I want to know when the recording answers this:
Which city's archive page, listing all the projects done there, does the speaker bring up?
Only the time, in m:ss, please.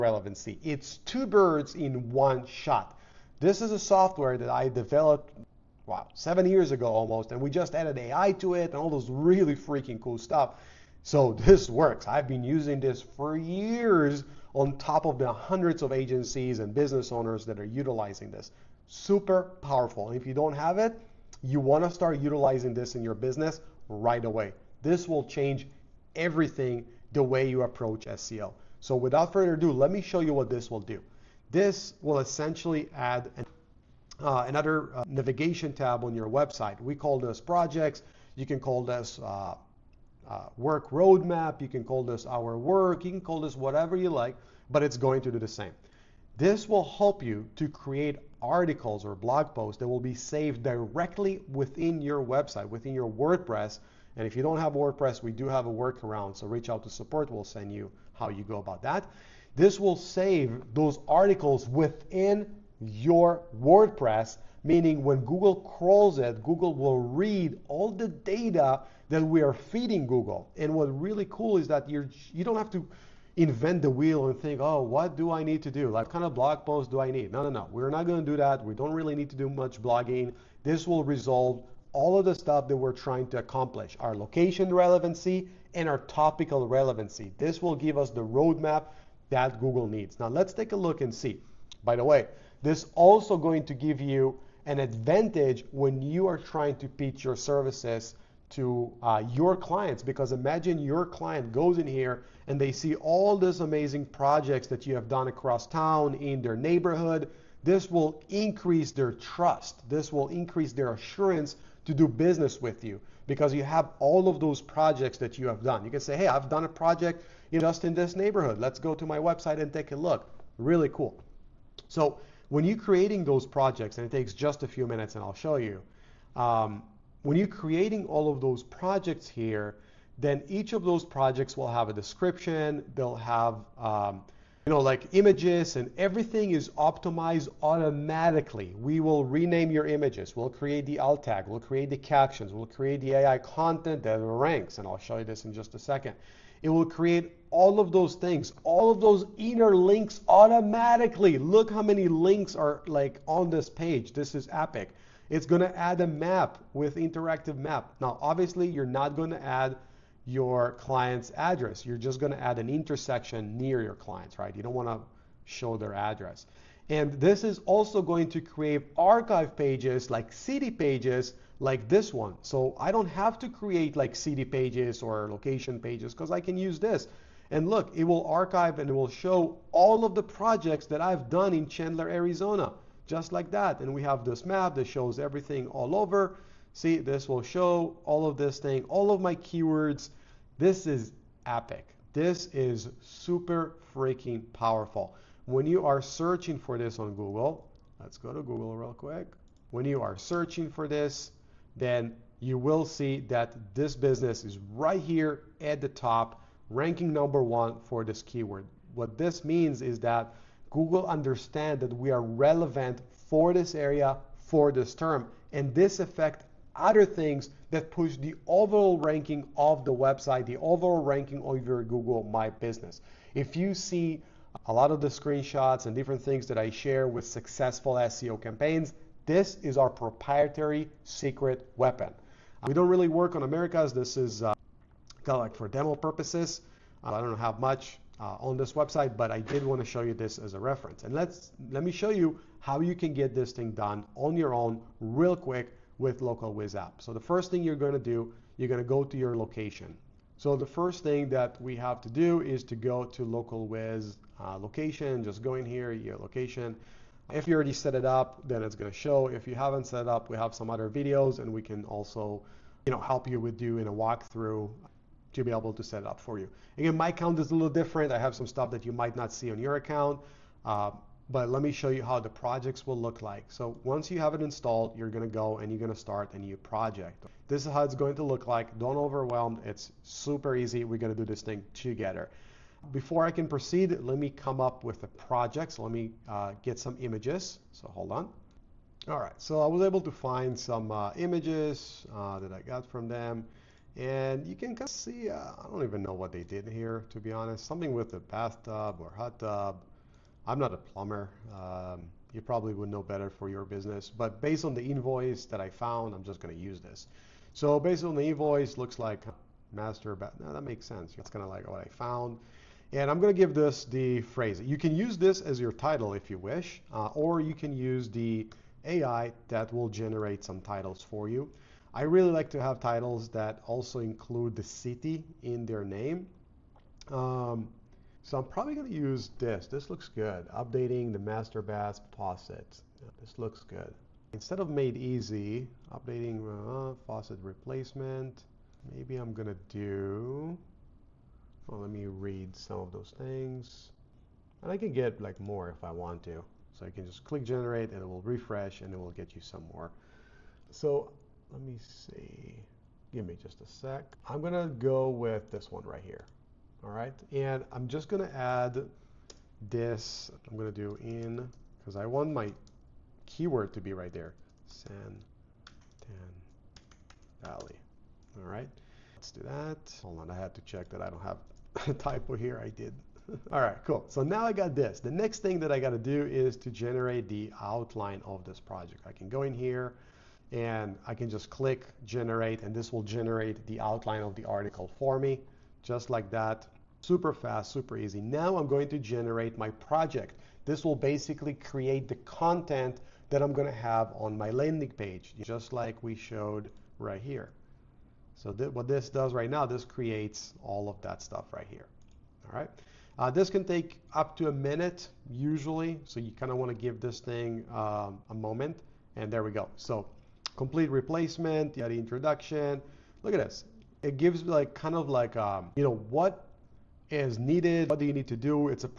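3:01.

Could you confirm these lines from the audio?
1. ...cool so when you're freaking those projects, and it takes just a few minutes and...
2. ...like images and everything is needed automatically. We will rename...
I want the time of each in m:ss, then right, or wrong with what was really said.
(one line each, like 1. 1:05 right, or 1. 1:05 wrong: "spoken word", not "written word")
1. 2:00 wrong: "creating", not "freaking"
2. 2:14 wrong: "optimized", not "needed".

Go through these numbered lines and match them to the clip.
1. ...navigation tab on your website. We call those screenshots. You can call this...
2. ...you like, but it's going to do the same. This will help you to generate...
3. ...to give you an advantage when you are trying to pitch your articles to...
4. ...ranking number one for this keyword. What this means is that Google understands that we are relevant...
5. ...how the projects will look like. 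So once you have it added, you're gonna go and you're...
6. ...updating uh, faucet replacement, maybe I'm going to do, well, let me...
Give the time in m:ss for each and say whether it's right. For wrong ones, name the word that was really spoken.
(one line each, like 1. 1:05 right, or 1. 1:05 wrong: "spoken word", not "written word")
1. 0:35 wrong: "projects", not "screenshots"
2. 0:43 wrong: "create", not "generate"
3. 1:33 wrong: "services", not "articles"
4. 3:26 right
5. 4:32 wrong: "installed", not "added"
6. 5:35 right.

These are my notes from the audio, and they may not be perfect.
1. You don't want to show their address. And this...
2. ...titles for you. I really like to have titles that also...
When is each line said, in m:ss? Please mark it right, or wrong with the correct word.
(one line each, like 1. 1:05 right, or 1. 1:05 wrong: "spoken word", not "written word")
1. 2:44 right
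2. 5:20 right.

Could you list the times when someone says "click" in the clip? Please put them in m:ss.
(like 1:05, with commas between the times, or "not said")
5:47, 6:21.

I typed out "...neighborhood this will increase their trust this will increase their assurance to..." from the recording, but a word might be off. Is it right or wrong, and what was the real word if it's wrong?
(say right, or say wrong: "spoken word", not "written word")
right.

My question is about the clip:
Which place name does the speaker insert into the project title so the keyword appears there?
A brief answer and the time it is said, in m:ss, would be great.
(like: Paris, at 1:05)
San Tan Valley, at 6:04.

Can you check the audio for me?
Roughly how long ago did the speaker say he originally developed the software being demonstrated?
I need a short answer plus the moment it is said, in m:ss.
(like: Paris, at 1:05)
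7 years, at 0:06.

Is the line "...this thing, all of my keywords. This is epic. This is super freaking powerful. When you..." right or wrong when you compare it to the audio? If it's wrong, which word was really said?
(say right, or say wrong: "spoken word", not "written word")
right.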